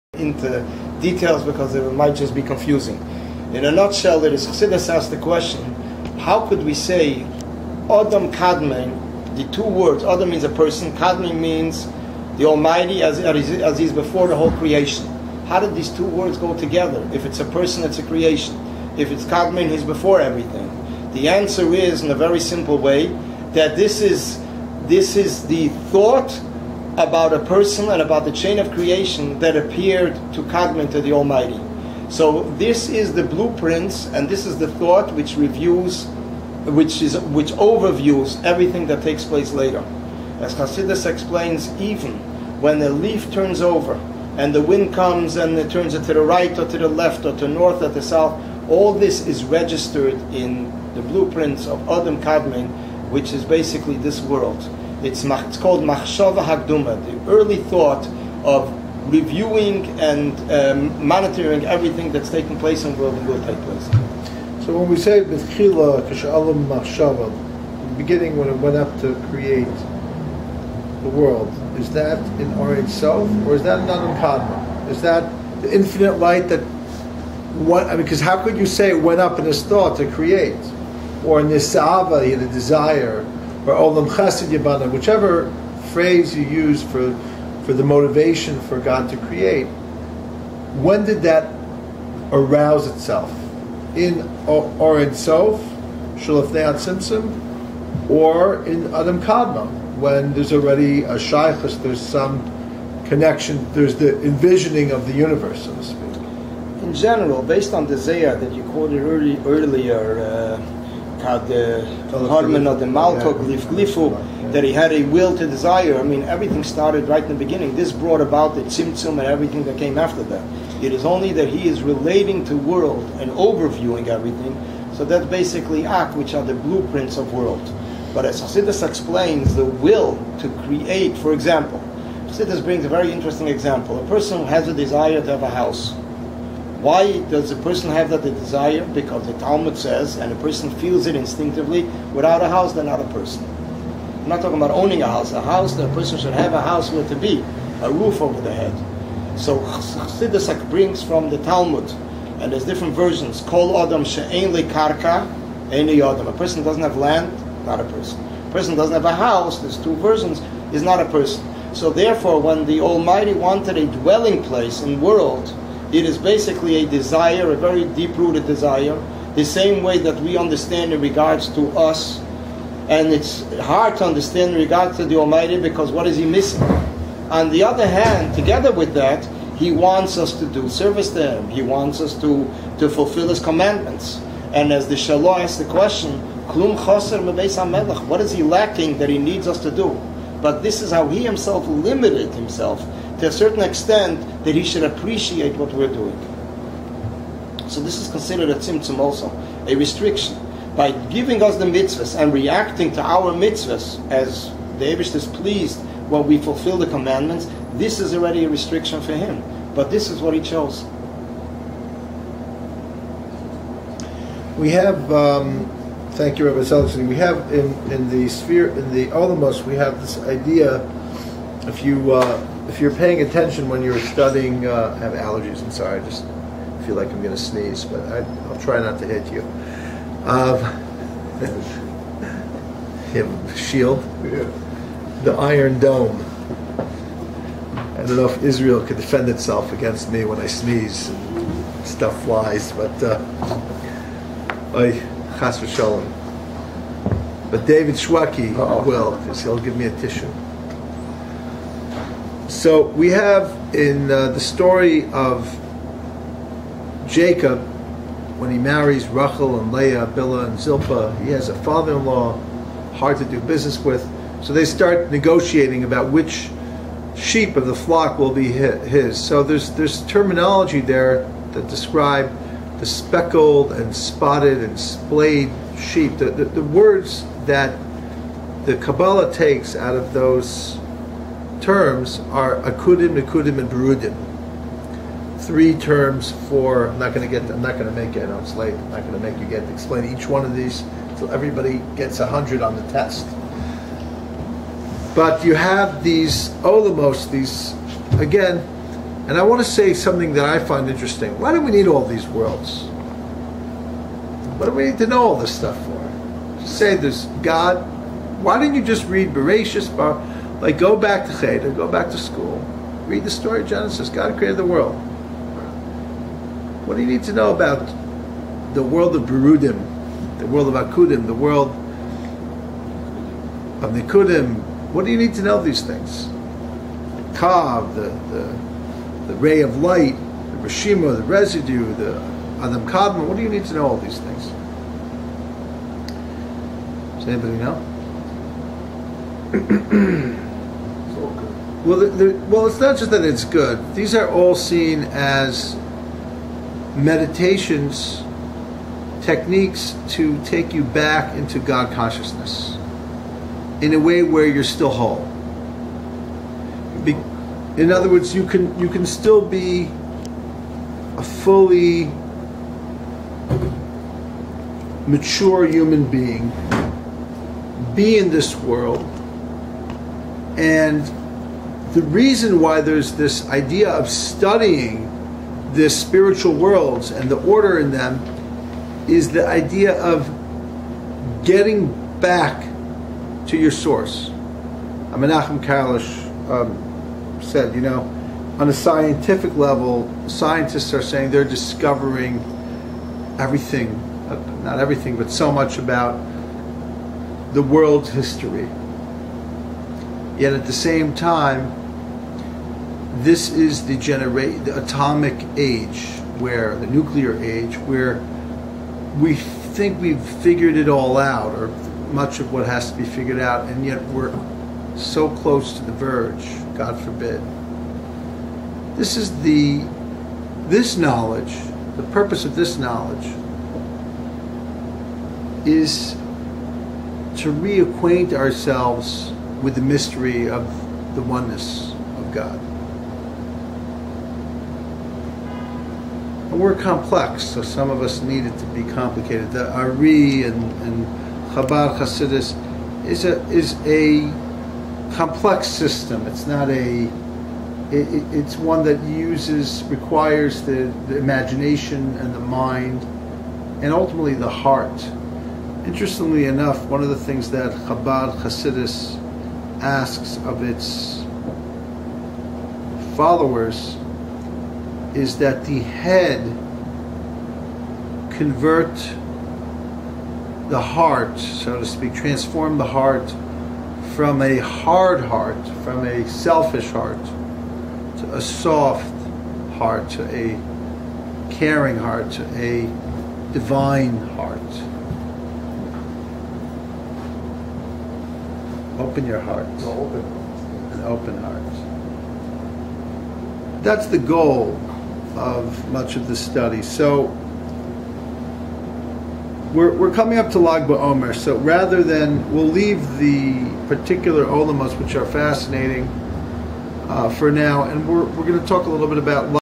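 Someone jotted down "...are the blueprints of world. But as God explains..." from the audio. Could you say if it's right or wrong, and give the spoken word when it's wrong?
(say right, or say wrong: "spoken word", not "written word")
wrong: "Hasidus", not "God".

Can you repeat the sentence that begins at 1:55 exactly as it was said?
I mean, everything started right in the beginning.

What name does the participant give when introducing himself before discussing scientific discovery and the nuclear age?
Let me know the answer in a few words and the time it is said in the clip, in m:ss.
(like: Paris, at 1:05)
Menachem Kalish, at 6:25.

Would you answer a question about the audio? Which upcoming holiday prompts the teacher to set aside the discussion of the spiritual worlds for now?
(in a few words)
Lag BaOmer.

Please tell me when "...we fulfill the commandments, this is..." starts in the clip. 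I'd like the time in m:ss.
3:26.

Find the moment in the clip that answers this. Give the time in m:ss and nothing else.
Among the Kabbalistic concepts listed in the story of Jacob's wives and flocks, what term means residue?
5:30.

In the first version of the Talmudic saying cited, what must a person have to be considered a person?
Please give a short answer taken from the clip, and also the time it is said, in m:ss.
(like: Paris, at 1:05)
land, at 2:36.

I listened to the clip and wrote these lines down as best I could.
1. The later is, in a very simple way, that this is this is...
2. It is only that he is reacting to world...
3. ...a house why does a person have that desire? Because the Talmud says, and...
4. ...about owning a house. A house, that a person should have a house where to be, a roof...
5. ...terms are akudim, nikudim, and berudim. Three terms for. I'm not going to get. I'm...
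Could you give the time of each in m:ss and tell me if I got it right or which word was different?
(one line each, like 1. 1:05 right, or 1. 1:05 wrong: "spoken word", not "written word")
1. 0:21 wrong: "answer", not "later"
2. 2:00 wrong: "relating", not "reacting"
3. 2:15 right
4. 2:24 right
5. 4:41 right.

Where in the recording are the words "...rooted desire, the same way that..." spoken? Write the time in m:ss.
2:48.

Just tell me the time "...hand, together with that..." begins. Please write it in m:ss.
2:57.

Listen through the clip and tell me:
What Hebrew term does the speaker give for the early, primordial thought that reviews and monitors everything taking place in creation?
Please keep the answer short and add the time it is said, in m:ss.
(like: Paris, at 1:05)
Machshava Hagduma, at 0:55.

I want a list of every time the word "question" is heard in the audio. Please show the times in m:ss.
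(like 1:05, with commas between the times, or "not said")
0:05, 3:05.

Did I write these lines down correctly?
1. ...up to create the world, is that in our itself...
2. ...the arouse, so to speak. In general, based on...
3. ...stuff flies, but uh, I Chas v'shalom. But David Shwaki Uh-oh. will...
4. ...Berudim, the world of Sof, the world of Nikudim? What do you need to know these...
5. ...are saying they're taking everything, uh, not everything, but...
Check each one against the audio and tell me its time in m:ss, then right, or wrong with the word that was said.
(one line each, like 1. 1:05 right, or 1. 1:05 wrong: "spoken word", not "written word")
1. 1:08 right
2. 1:45 wrong: "universe", not "arouse"
3. 4:01 right
4. 5:19 wrong: "Akudim", not "Sof"
5. 6:30 wrong: "discovering", not "taking".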